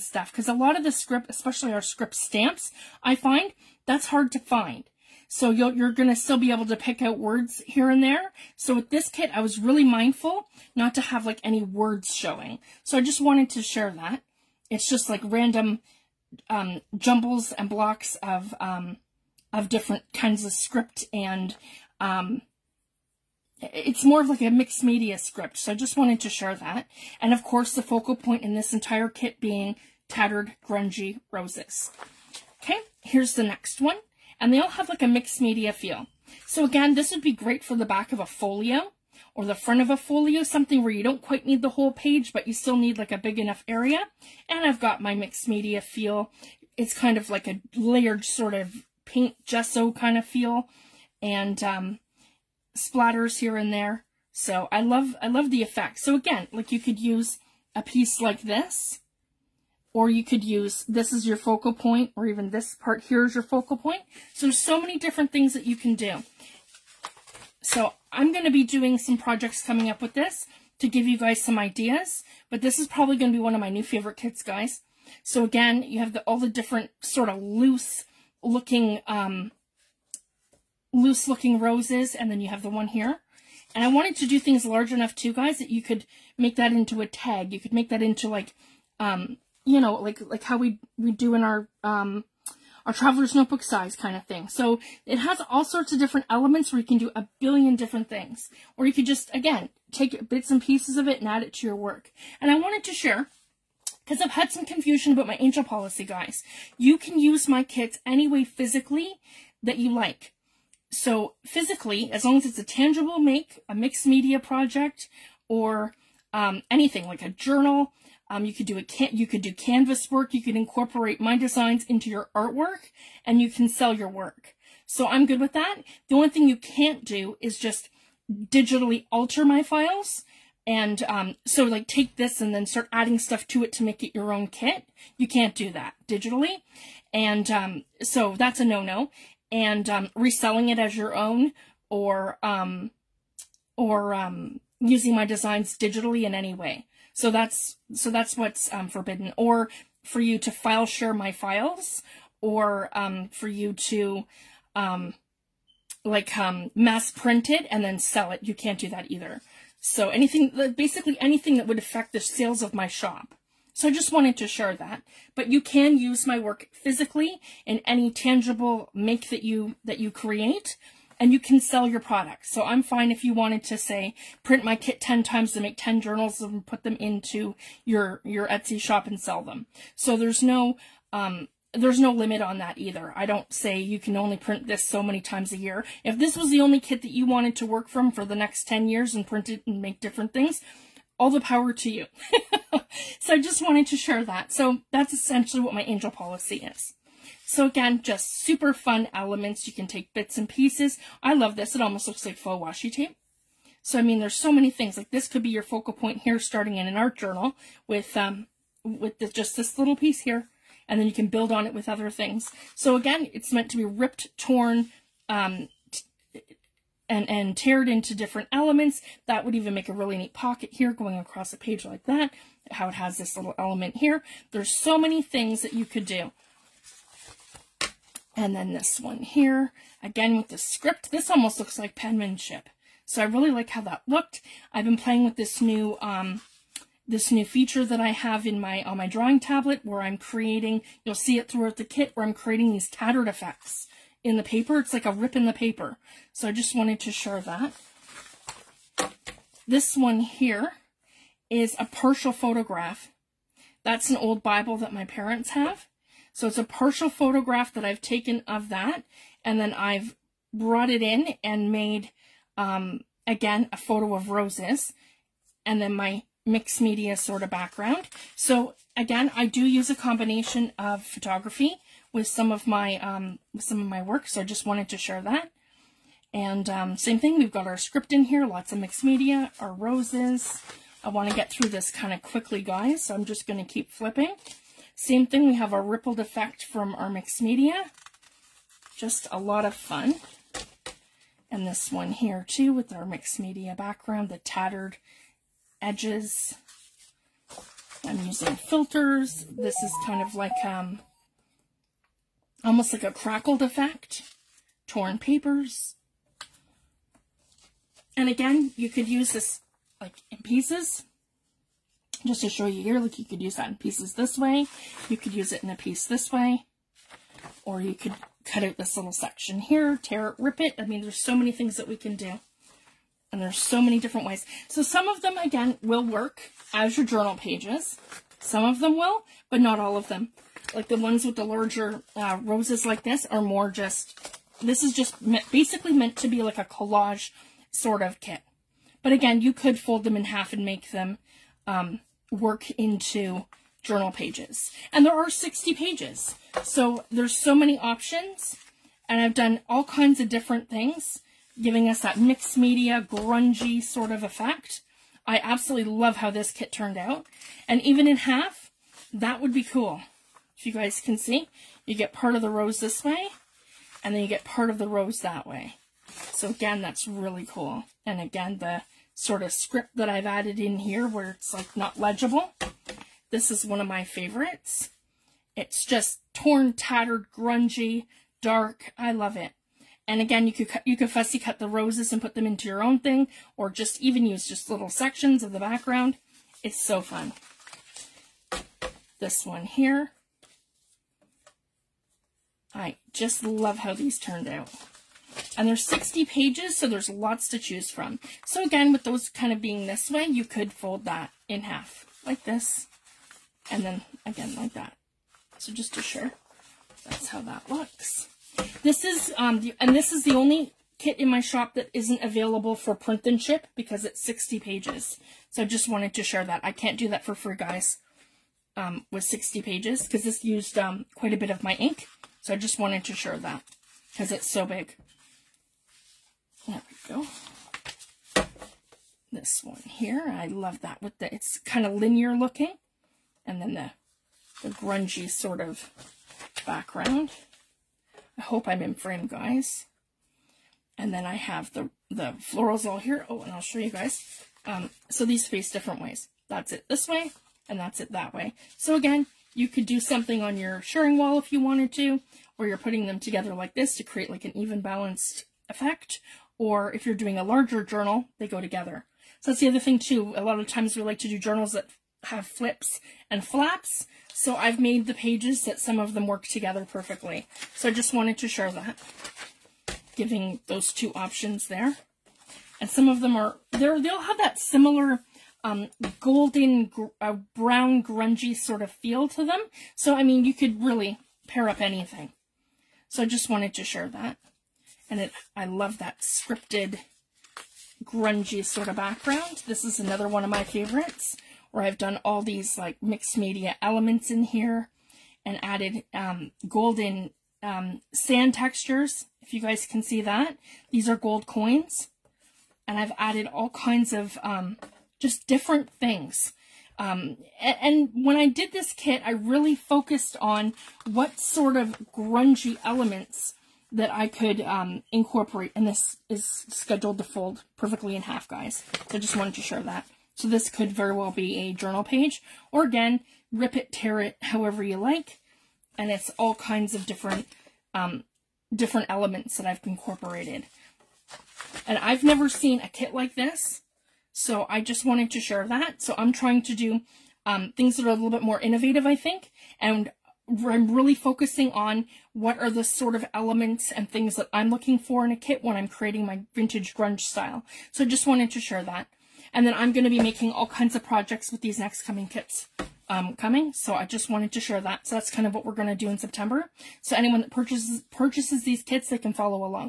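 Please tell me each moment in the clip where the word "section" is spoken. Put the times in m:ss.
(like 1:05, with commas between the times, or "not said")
5:19, 6:24.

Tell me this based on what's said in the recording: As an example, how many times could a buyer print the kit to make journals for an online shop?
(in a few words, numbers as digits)
10.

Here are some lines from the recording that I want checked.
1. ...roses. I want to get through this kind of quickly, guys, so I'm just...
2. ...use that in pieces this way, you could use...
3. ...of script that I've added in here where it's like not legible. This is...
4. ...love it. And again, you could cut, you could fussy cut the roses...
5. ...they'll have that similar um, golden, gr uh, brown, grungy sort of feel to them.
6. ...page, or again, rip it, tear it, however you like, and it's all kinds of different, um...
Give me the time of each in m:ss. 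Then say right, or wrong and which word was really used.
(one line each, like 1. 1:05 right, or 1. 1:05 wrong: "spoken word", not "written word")
1. 4:39 right
2. 5:13 right
3. 6:09 right
4. 6:19 right
5. 7:54 right
6. 8:42 right.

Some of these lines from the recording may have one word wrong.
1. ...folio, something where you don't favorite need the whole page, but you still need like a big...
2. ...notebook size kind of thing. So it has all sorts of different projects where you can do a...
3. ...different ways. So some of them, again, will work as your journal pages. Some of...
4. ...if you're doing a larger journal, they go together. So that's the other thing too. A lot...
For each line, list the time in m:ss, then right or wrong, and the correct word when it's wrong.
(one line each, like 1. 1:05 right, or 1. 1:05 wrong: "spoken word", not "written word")
1. 0:39 wrong: "quite", not "favorite"
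2. 1:33 wrong: "elements", not "projects"
3. 5:23 right
4. 7:36 right.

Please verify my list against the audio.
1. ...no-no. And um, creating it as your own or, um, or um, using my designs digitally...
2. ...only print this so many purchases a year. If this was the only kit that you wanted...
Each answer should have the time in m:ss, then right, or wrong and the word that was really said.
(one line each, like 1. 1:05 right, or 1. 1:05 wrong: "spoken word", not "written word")
1. 2:18 wrong: "reselling", not "creating"
2. 3:04 wrong: "times", not "purchases".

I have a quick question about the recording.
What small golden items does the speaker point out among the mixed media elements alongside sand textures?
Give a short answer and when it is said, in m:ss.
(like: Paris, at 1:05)
gold coins, at 8:21.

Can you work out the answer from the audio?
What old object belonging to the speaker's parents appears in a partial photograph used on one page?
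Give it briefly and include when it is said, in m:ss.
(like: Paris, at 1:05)
Bible, at 4:14.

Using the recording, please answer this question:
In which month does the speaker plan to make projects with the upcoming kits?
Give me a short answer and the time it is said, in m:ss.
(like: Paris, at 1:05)
September, at 9:16.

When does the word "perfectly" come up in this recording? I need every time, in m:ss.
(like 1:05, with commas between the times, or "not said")
7:46, 8:37.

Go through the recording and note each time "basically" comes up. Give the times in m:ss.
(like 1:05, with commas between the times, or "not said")
2:40, 5:35.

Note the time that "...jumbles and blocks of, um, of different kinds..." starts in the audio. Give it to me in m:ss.
0:16.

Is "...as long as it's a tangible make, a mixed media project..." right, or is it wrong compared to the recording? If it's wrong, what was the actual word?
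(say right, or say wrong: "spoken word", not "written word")
right.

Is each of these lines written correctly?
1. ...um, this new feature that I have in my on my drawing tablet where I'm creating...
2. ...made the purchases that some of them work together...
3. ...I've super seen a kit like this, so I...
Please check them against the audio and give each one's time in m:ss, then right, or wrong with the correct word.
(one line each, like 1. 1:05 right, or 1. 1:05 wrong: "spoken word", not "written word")
1. 3:56 right
2. 7:44 wrong: "pages", not "purchases"
3. 8:51 wrong: "never", not "super".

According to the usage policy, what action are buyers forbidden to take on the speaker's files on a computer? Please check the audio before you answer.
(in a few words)
digitally alter.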